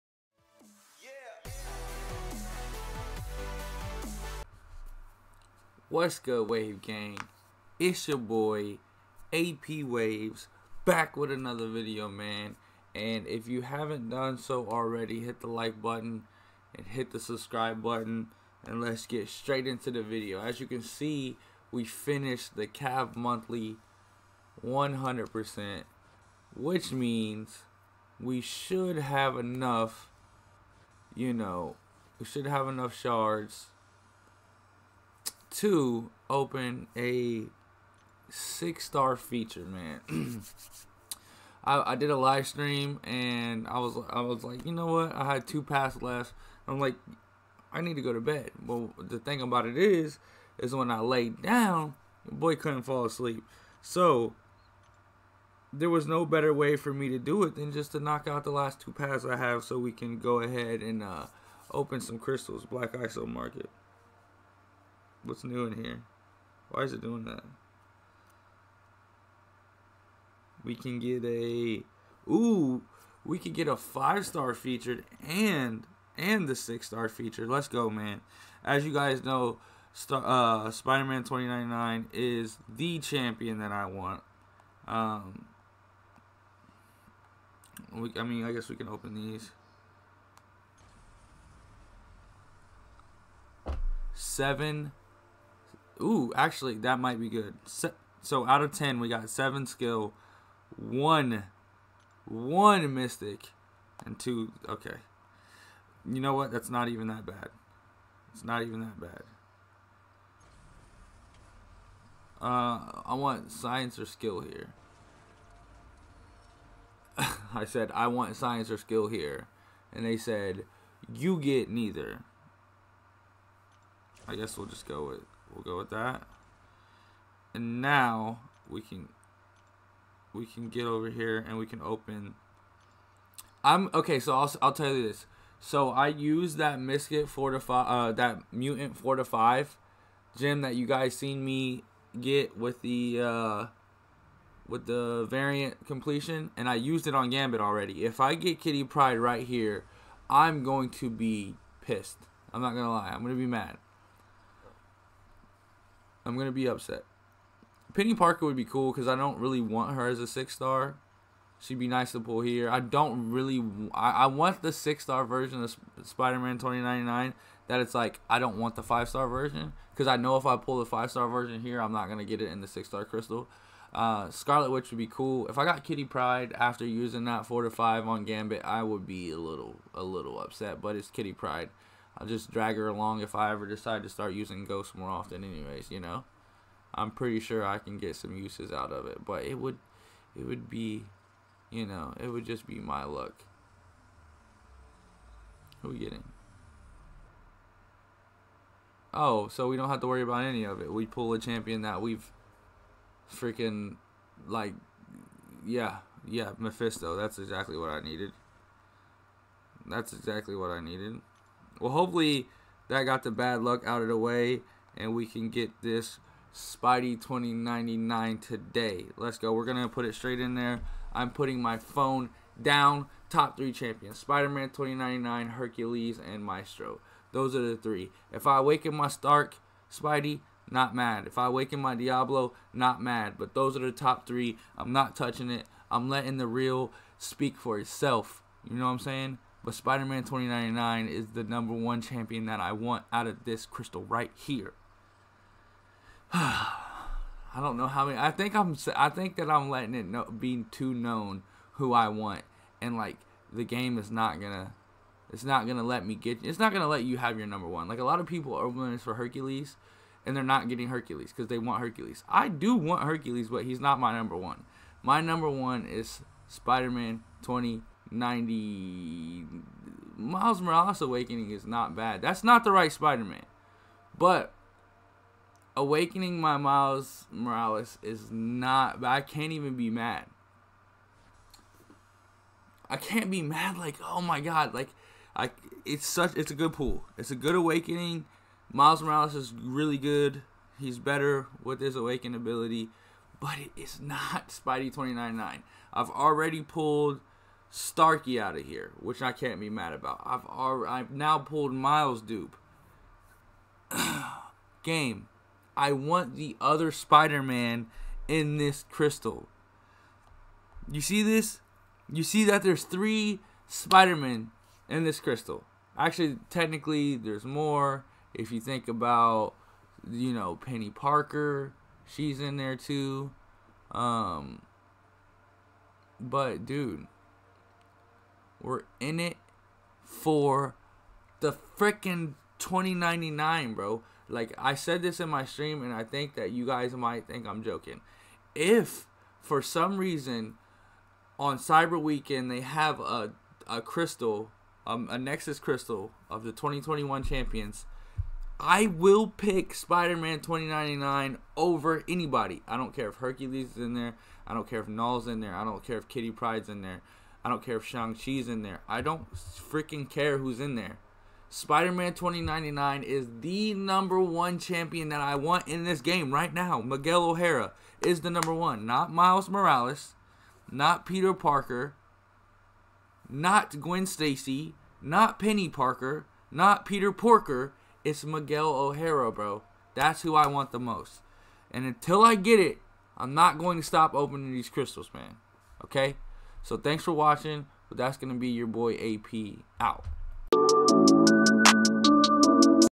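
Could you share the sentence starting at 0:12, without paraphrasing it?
And if you haven't done so already, hit the like button and hit the subscribe button.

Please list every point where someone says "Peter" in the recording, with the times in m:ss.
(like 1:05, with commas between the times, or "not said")
6:11, 6:16.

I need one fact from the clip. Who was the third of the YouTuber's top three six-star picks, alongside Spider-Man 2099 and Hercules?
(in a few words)
Maestro.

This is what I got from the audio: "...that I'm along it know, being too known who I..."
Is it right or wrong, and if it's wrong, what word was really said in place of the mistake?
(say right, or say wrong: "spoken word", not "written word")
wrong: "letting", not "along".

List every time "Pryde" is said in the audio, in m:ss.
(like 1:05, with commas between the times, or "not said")
2:28, 2:56, 3:01, 5:56.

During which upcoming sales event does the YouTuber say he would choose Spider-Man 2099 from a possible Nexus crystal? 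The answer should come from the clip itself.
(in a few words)
Cyber Weekend.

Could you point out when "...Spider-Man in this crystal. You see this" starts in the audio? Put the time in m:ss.
5:06.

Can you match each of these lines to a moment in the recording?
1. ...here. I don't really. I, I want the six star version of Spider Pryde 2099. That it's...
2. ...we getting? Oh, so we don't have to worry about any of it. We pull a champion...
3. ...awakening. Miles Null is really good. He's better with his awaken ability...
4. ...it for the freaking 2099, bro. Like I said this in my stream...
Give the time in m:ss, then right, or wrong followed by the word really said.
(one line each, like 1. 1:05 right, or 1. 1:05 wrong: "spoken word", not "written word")
1. 2:42 wrong: "Man", not "Pryde"
2. 3:15 right
3. 4:47 wrong: "Morales", not "Null"
4. 5:29 right.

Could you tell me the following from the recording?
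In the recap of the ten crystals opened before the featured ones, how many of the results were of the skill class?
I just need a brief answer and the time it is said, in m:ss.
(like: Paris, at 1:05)
7, at 1:39.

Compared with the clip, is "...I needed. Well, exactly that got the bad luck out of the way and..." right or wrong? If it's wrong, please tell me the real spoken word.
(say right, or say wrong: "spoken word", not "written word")
wrong: "hopefully", not "exactly".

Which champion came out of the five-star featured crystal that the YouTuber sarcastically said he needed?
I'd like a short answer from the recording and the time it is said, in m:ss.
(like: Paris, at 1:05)
Mephisto, at 3:26.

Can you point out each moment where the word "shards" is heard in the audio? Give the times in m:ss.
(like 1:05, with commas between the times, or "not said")
0:32.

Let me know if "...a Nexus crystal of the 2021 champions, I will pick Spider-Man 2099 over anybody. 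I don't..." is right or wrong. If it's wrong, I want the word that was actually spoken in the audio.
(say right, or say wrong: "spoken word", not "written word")
right.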